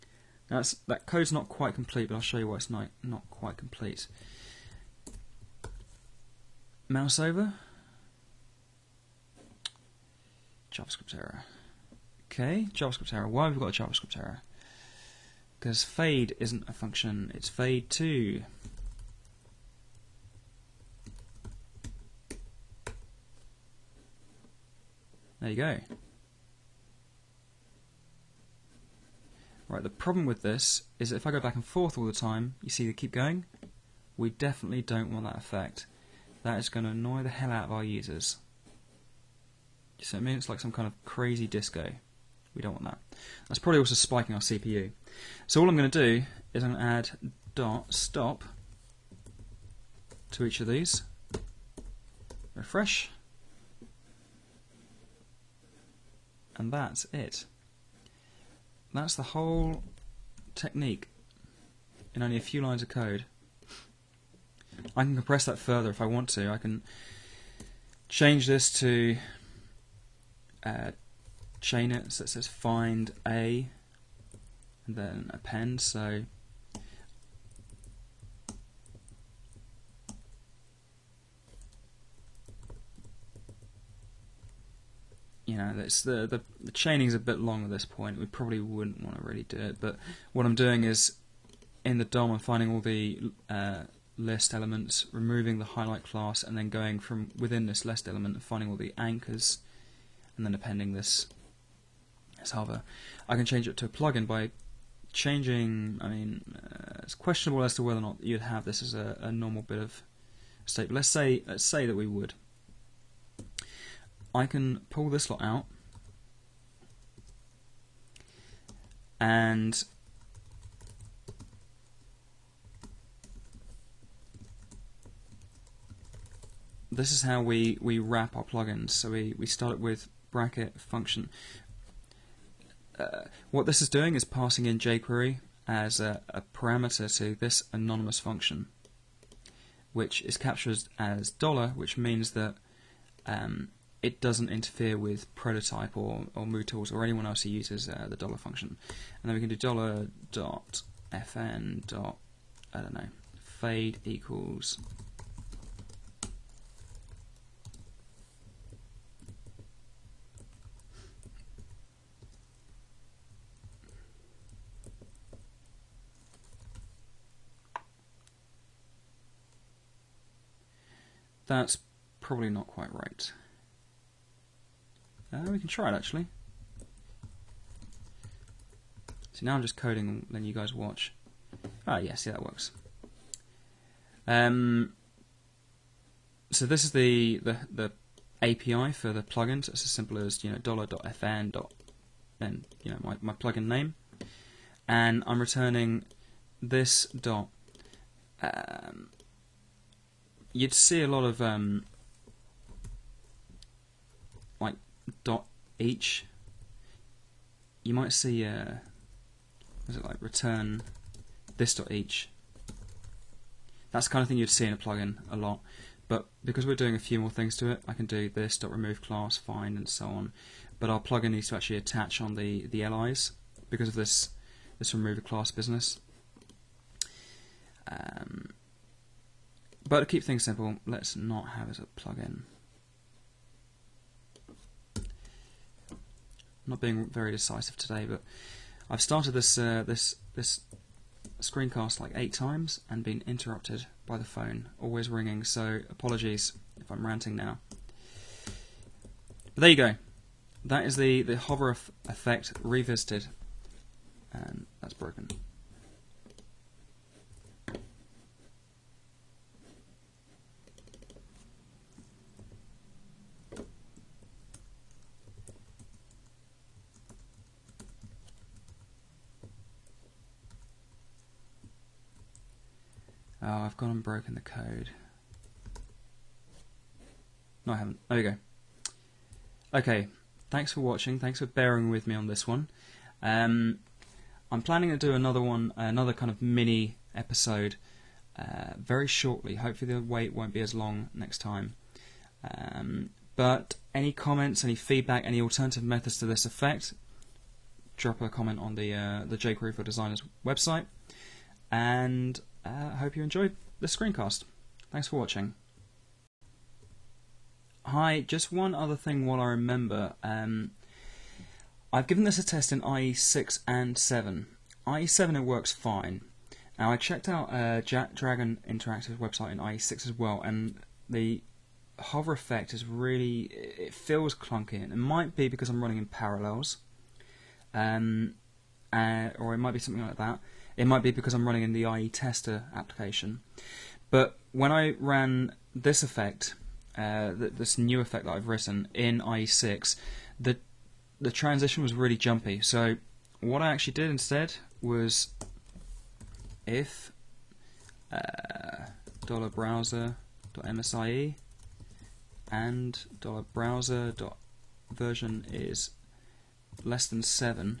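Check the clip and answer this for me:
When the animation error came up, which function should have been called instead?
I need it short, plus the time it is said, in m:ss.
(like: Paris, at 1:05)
fade 2, at 0:17.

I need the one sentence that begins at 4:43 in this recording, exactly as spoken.
Um, I'm planning to do another one, another kind of mini episode uh, very shortly.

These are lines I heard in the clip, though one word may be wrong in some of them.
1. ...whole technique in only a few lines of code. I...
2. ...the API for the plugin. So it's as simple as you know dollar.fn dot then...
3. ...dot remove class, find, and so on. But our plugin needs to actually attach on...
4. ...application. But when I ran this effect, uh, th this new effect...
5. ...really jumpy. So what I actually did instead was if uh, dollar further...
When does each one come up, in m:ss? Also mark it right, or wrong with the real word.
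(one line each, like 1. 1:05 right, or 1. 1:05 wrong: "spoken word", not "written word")
1. 0:59 right
2. 3:07 right
3. 3:38 right
4. 5:32 right
5. 5:41 wrong: "browser", not "further".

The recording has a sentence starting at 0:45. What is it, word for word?
So all I'm going to do is I'm going to add dot stop to each of these.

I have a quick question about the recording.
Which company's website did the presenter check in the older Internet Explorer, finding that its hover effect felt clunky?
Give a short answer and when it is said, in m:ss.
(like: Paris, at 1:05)
Jack Dragon Interactive, at 5:17.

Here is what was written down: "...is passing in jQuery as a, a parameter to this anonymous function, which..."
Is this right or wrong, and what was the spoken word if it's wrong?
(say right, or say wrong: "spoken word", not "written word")
right.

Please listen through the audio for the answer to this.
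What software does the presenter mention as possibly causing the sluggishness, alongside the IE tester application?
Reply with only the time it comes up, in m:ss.
5:26.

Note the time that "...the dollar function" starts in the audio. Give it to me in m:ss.
2:28.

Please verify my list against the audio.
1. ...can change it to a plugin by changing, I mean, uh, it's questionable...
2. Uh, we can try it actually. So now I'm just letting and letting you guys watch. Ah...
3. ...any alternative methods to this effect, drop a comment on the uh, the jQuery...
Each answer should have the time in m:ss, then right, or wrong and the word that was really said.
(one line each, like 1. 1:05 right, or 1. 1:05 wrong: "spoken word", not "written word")
1. 1:43 right
2. 2:55 wrong: "coding", not "letting"
3. 4:55 right.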